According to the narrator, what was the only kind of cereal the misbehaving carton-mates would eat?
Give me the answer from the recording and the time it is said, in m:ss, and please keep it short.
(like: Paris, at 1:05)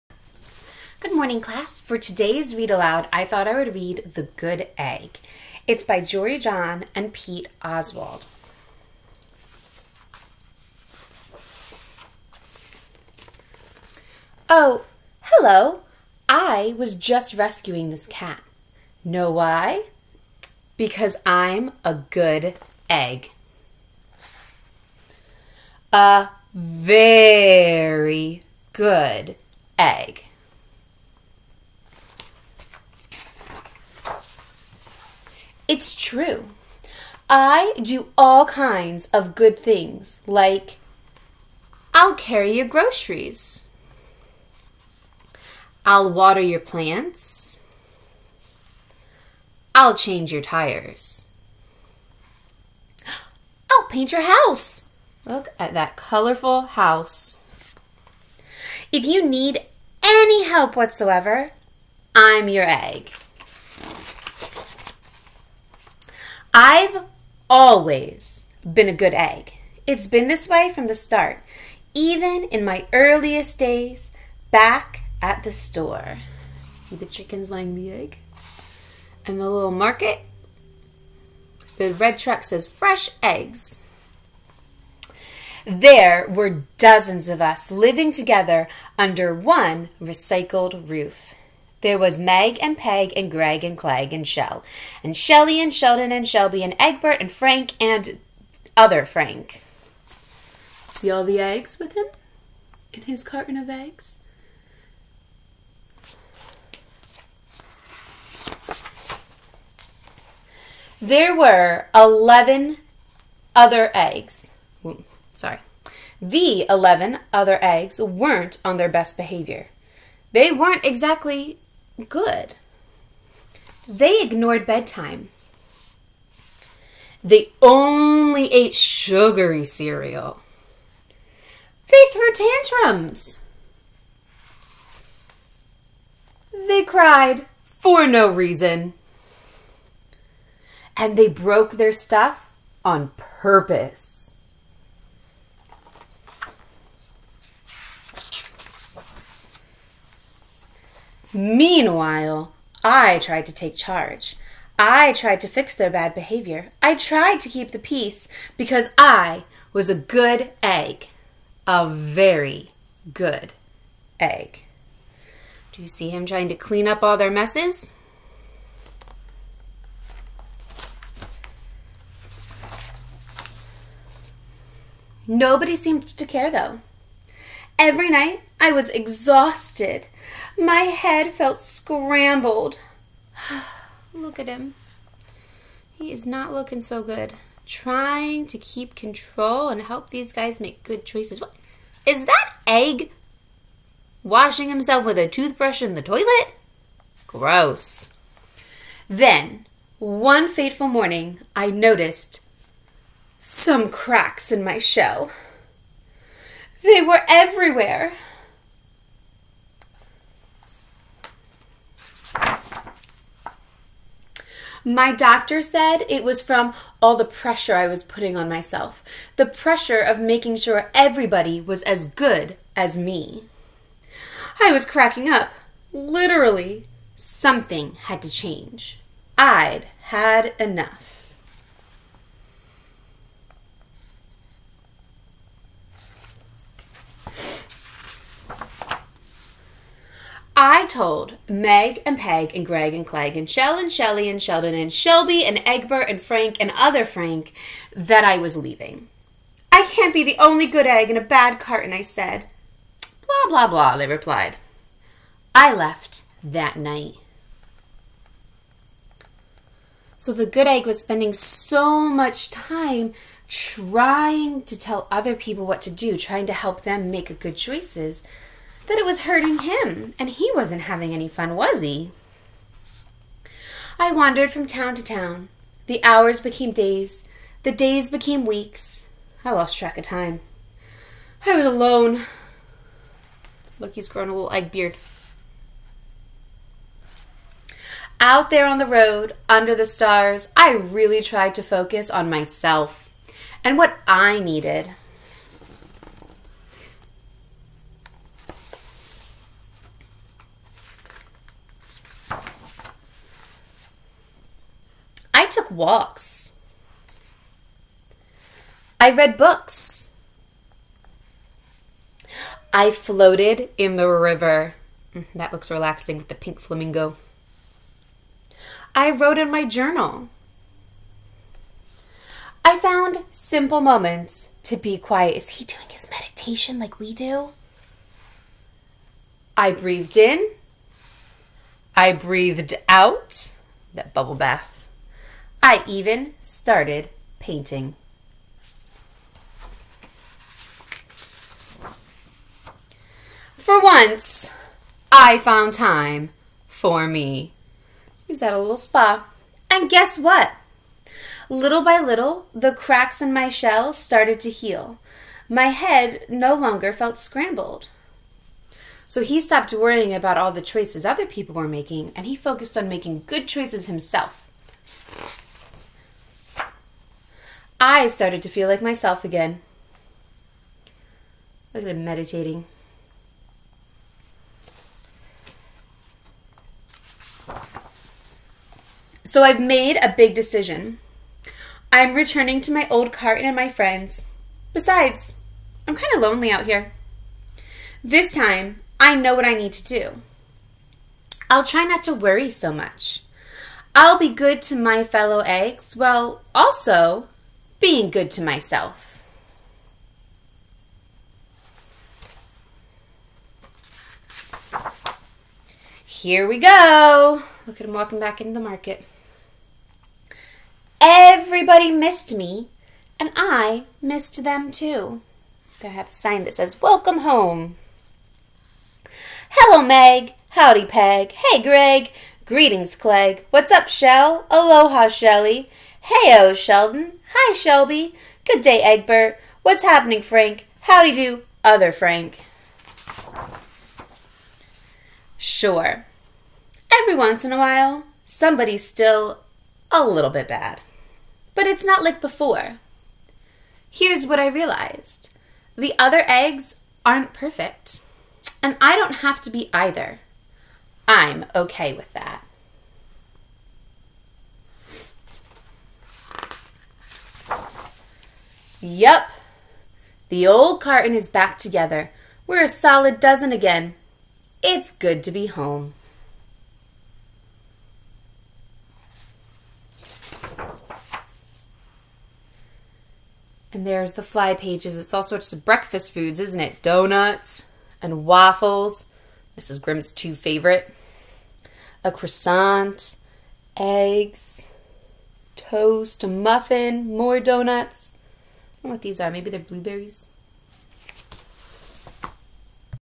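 Sugary cereal, at 2:08.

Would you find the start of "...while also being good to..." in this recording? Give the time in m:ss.
6:35.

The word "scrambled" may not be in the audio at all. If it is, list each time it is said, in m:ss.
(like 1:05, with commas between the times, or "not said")
3:01, 5:57.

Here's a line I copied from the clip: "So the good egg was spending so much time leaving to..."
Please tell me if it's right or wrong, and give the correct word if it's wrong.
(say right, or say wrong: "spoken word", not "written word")
wrong: "trying", not "leaving".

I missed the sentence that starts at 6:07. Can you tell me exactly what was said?
I started to feel like myself again.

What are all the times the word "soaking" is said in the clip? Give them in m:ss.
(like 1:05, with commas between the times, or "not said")
not said.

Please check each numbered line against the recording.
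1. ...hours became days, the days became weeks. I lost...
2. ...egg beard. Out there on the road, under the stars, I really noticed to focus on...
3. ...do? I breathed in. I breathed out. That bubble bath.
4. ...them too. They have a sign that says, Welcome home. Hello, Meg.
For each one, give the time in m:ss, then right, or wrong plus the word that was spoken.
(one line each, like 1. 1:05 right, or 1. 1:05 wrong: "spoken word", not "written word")
1. 4:36 right
2. 4:44 wrong: "tried", not "noticed"
3. 5:27 right
4. 6:54 right.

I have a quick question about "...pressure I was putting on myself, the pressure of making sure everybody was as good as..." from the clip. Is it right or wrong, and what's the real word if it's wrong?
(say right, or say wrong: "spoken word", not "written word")
right.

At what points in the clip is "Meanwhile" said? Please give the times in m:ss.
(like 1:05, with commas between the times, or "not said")
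2:31.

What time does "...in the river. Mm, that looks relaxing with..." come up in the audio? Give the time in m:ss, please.
5:13.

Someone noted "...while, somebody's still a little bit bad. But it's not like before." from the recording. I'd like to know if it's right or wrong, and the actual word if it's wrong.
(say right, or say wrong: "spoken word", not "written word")
right.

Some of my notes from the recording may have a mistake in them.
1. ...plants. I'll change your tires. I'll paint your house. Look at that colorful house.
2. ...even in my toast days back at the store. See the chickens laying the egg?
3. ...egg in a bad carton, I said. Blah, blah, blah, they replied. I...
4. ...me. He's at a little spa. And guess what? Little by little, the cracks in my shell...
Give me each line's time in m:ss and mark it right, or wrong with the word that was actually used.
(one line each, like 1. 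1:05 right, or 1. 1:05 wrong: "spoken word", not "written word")
1. 0:46 right
2. 1:11 wrong: "earliest", not "toast"
3. 4:10 right
4. 5:47 right.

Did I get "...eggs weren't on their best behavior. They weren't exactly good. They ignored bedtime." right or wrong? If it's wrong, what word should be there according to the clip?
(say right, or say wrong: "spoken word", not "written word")
right.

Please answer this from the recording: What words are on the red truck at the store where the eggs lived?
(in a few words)
Fresh eggs.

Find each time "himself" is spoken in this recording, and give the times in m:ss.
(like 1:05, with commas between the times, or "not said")
3:14, 6:03.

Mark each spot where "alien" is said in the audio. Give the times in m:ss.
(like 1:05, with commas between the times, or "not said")
not said.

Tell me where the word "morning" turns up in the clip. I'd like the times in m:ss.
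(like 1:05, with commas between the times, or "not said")
0:01, 3:20.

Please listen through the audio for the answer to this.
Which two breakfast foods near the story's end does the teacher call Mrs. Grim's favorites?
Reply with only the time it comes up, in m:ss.
7:56.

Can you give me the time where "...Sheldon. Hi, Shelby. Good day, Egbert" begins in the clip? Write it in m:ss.
7:06.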